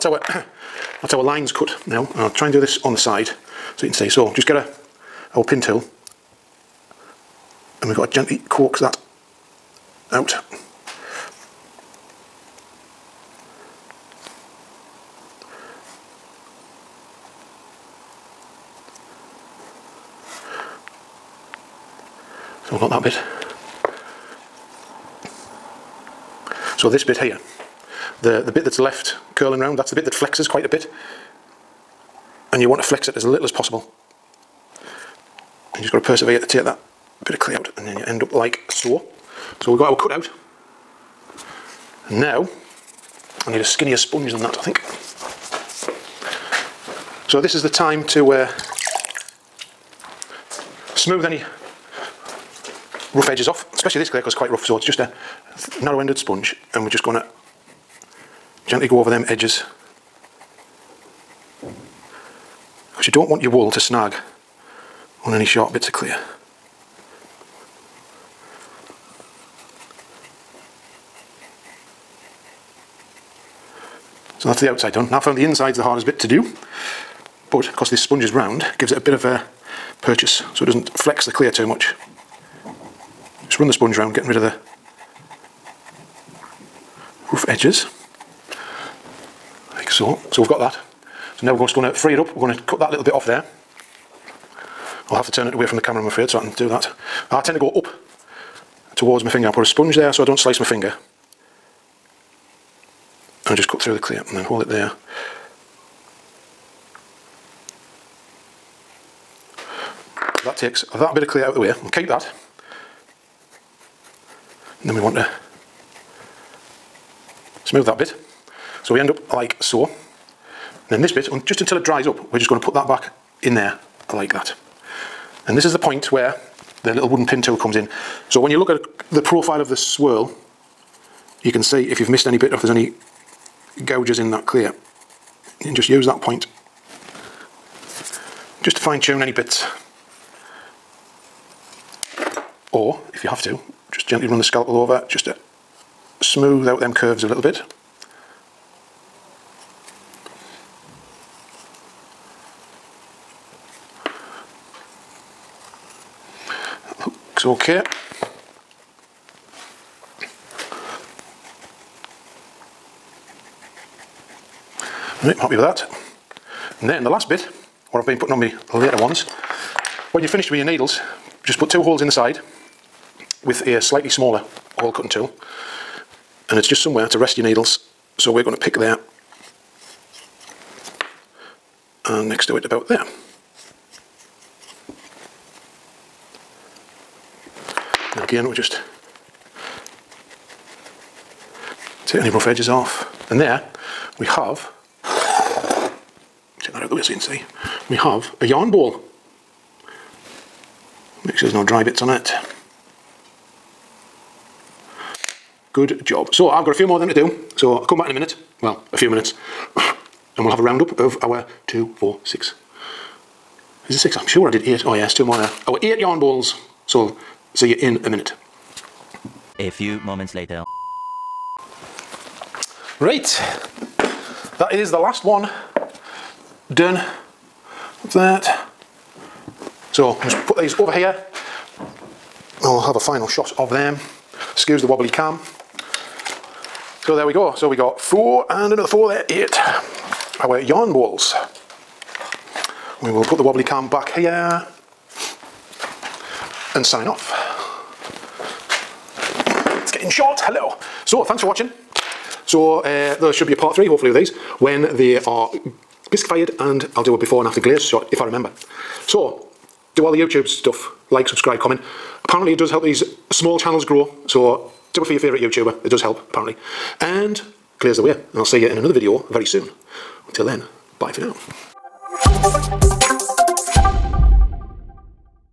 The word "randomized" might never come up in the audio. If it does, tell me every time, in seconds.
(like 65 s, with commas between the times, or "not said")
not said.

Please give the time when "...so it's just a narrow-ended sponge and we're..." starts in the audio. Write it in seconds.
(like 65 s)
54 s.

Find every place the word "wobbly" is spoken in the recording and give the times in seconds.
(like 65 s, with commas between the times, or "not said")
234 s, 243 s.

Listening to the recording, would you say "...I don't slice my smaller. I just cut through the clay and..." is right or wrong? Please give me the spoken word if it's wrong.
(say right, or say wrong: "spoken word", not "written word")
wrong: "finger", not "smaller".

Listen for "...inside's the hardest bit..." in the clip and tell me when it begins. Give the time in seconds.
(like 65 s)
75 s.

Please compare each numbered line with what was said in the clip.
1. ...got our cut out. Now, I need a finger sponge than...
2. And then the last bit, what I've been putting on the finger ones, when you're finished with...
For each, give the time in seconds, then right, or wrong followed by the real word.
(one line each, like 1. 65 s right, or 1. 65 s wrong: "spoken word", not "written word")
1. 39 s wrong: "skinnier", not "finger"
2. 166 s wrong: "later", not "finger".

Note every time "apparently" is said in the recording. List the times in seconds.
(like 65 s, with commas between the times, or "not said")
262 s, 266 s.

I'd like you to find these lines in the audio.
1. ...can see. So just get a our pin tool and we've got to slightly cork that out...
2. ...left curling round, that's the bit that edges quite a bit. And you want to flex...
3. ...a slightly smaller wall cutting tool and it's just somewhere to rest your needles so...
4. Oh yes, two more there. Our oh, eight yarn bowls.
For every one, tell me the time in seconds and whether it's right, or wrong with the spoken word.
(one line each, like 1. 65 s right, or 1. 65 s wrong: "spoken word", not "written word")
1. 3 s wrong: "gently", not "slightly"
2. 28 s wrong: "flexes", not "edges"
3. 173 s right
4. 214 s right.